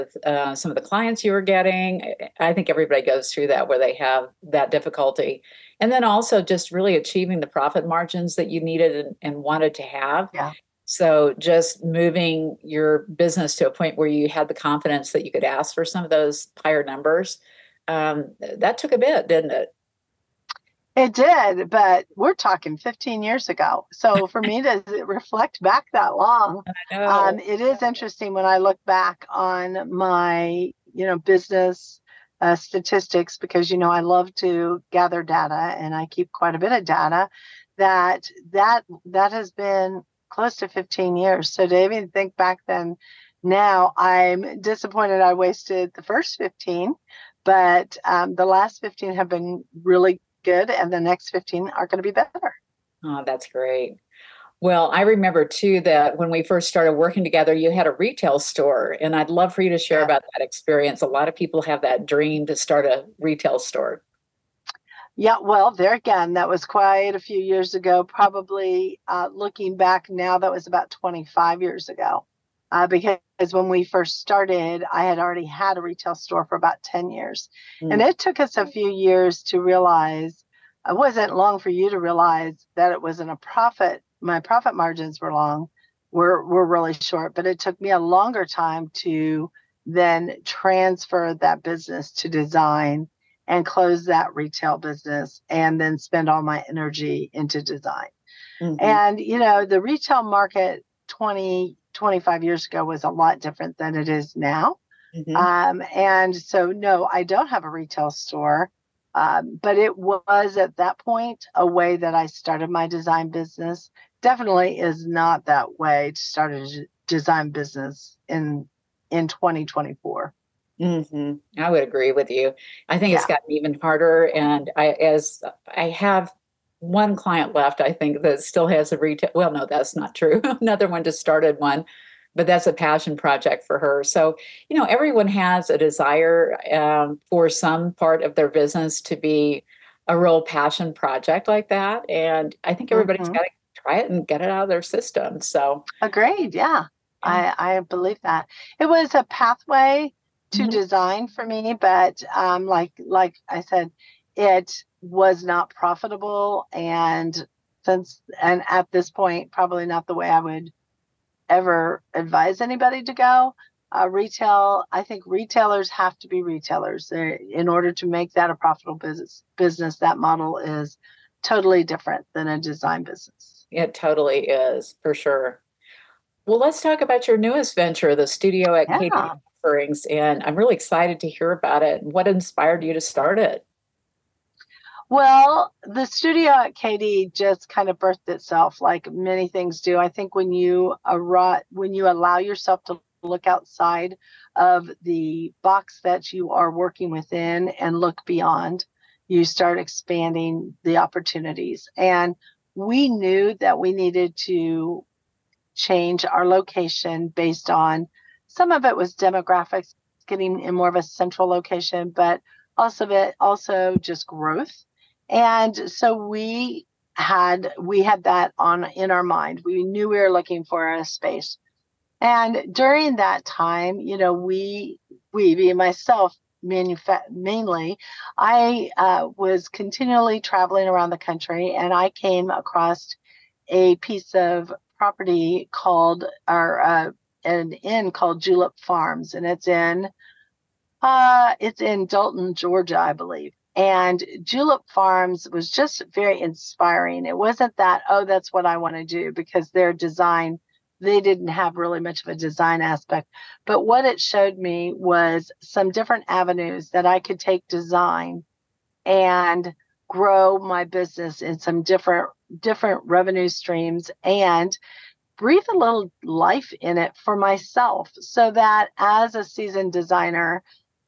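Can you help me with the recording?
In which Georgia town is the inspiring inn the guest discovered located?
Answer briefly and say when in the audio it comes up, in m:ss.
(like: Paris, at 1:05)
Dalton, at 4:02.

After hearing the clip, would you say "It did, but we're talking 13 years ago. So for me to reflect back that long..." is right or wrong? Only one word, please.
wrong.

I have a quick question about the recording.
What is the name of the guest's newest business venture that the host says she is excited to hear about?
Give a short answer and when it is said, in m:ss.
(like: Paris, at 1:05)
The Studio at KD, at 3:05.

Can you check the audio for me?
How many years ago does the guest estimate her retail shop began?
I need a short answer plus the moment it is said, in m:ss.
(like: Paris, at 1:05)
25, at 1:10.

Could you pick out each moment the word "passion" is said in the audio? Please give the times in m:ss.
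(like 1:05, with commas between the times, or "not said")
2:12, 2:20.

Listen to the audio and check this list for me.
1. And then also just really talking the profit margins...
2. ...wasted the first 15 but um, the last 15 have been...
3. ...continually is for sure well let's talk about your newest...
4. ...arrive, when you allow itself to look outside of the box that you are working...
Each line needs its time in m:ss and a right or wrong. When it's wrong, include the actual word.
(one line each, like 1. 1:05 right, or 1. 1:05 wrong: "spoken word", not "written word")
1. 0:05 wrong: "achieving", not "talking"
2. 0:45 right
3. 2:53 wrong: "totally", not "continually"
4. 3:11 wrong: "yourself", not "itself".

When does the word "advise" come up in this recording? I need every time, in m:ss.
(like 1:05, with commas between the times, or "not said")
2:42.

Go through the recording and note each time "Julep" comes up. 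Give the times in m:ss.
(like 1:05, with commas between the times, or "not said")
3:58, 4:04.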